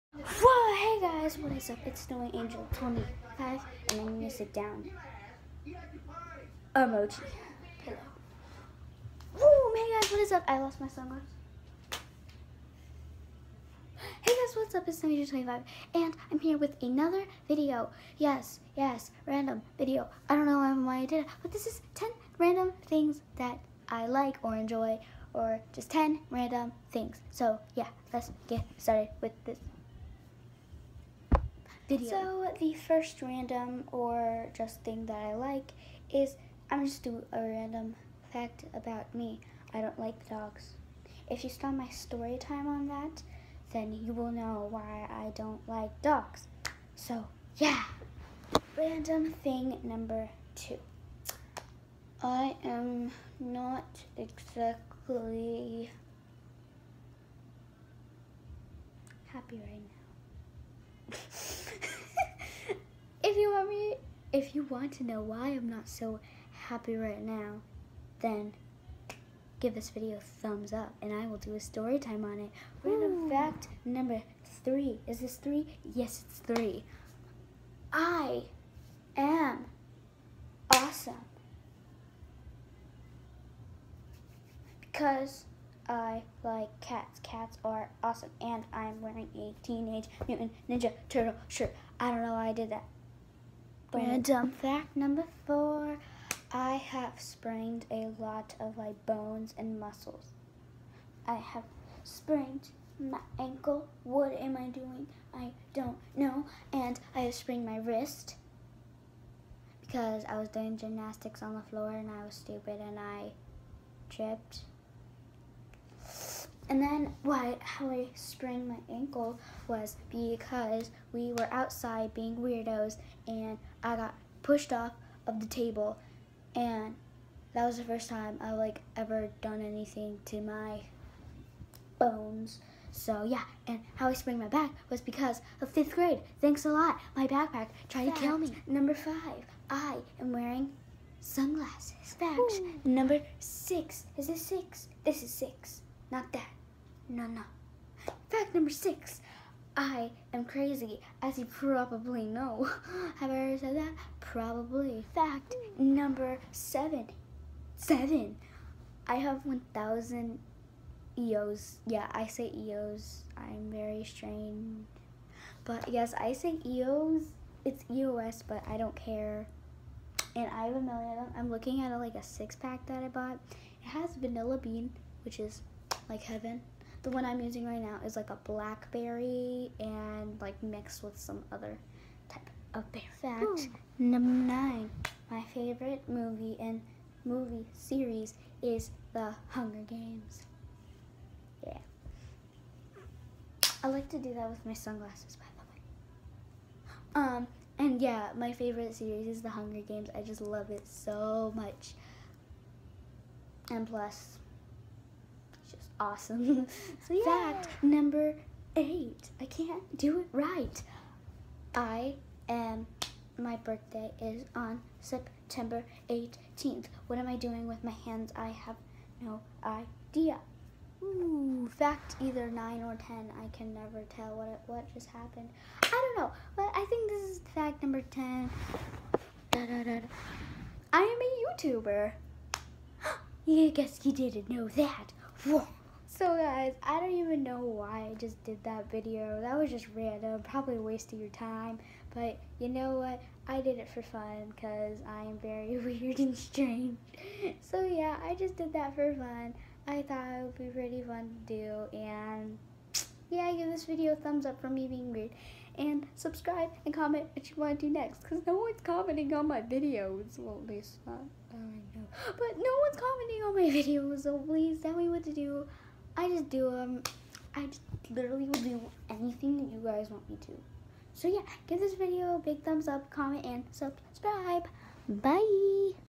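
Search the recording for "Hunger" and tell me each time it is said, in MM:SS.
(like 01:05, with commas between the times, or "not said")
03:09, 03:19.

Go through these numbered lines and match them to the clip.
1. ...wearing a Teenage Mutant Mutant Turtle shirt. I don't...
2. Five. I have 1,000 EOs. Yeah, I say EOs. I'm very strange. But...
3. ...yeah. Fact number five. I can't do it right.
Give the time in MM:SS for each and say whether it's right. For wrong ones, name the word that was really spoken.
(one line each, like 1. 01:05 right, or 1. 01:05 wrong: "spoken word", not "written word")
1. 01:29 wrong: "Ninja", not "Mutant"
2. 02:37 wrong: "Seven", not "Five"
3. 03:27 wrong: "eight", not "five".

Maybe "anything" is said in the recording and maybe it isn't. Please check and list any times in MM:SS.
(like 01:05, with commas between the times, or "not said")
02:09, 04:29.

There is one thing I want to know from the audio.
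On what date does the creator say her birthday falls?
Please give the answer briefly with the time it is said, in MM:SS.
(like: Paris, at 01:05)
September 18, at 03:34.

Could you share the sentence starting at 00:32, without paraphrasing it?
So the first random or just thing that I like is I'm just do a random fact about me.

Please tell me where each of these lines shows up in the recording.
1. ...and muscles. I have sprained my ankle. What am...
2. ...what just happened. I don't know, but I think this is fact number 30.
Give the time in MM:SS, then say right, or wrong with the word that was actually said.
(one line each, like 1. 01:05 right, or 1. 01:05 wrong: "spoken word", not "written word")
1. 01:39 right
2. 03:44 wrong: "10", not "30".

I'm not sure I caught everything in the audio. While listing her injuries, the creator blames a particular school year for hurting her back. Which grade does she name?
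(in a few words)
Fifth grade.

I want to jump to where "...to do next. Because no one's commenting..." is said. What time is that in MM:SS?
04:17.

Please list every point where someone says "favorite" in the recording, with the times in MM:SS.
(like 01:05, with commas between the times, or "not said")
03:05, 03:18.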